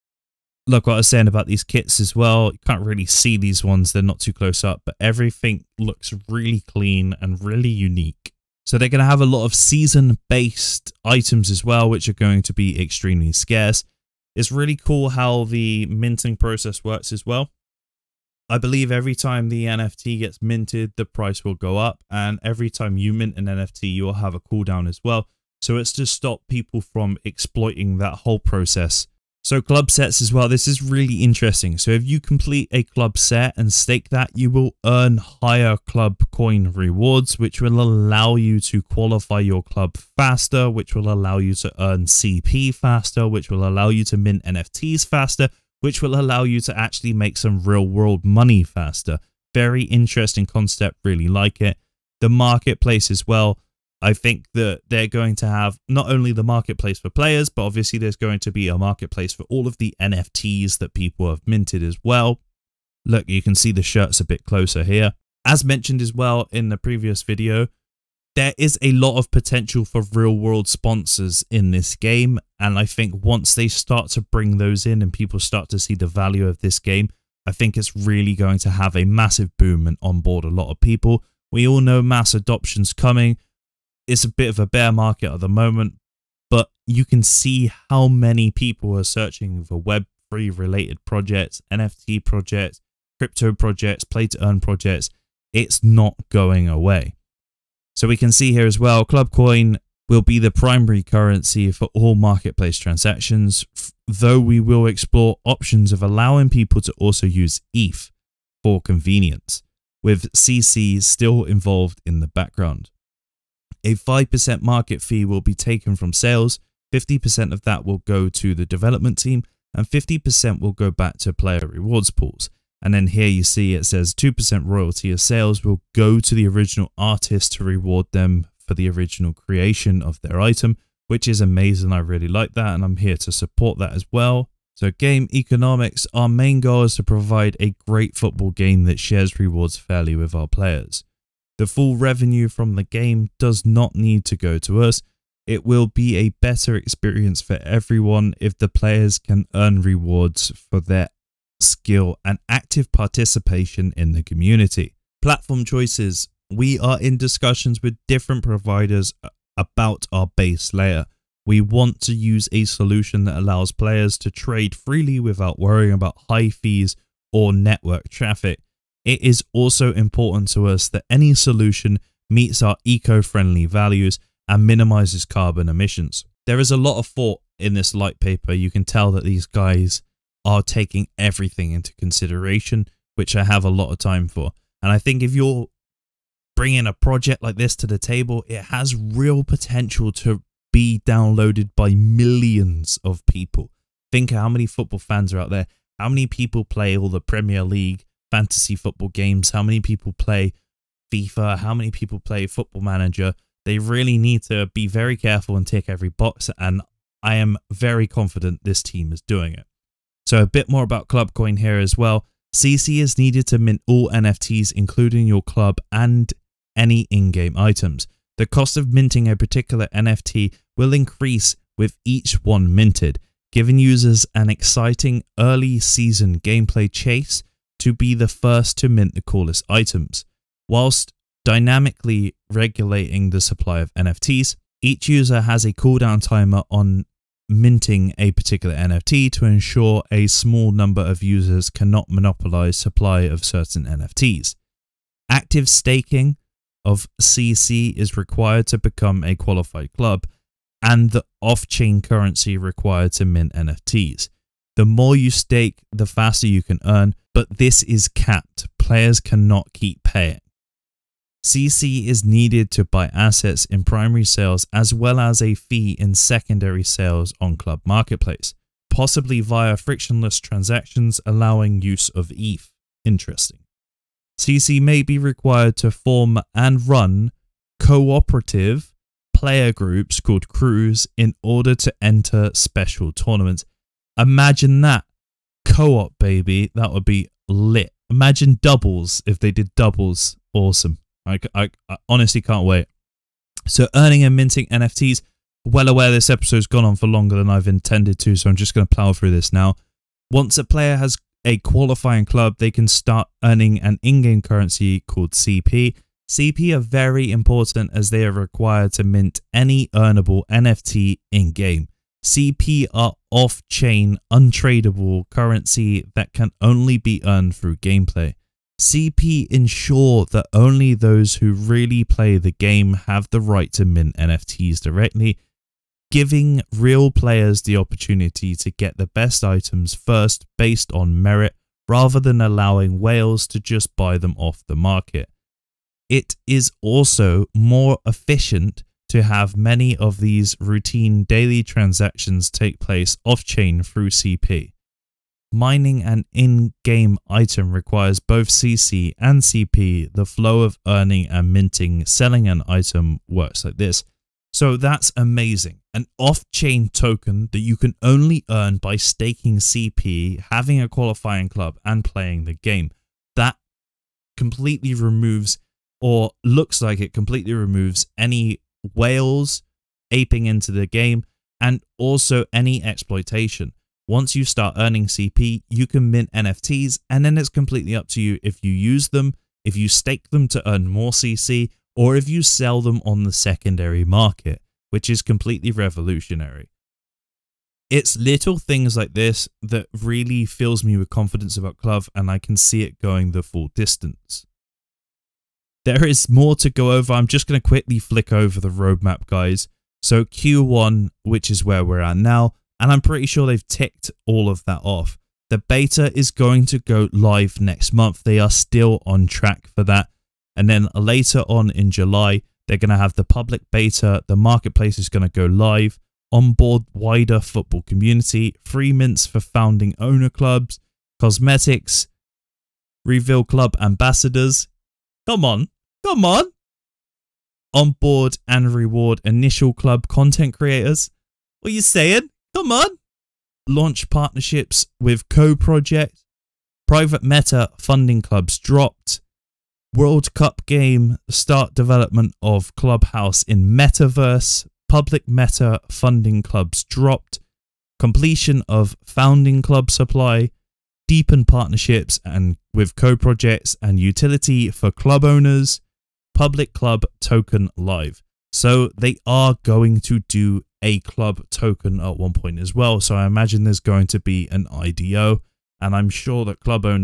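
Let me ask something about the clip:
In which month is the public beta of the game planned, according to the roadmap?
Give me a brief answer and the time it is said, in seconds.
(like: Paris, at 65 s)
July, at 411 s.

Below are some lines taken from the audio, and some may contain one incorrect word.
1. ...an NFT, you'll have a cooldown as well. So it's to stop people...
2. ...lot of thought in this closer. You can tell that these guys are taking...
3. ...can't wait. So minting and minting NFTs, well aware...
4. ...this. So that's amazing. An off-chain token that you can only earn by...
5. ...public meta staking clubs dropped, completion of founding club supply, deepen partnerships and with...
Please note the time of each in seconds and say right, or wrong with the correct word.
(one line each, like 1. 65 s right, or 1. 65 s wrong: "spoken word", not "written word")
1. 23 s right
2. 176 s wrong: "litepaper", not "closer"
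3. 292 s wrong: "earning", not "minting"
4. 353 s right
5. 444 s wrong: "funding", not "staking".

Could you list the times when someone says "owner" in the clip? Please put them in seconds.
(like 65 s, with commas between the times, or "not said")
419 s, 455 s.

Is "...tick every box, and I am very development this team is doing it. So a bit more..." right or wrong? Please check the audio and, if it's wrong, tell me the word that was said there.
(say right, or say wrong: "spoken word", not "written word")
wrong: "confident", not "development".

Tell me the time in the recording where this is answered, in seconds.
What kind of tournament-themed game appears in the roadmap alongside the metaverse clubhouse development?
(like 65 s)
439 s.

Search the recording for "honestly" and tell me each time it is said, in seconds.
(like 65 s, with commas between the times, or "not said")
292 s.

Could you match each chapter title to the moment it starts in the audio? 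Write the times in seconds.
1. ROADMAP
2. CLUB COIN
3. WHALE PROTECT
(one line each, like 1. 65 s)
1. 402 s
2. 162 s
3. 312 s.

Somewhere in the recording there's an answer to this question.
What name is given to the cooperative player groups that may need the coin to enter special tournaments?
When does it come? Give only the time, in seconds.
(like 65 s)
280 s.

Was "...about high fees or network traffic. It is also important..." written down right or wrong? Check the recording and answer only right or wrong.
right.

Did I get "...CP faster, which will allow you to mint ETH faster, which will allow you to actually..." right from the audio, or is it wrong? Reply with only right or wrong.
wrong.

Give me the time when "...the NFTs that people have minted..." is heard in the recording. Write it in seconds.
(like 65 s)
59 s.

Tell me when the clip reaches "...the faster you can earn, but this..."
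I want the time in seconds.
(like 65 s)
255 s.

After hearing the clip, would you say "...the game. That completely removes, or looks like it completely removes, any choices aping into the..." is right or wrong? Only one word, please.
wrong.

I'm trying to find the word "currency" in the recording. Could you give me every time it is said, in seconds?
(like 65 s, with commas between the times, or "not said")
101 s, 252 s, 304 s, 315 s.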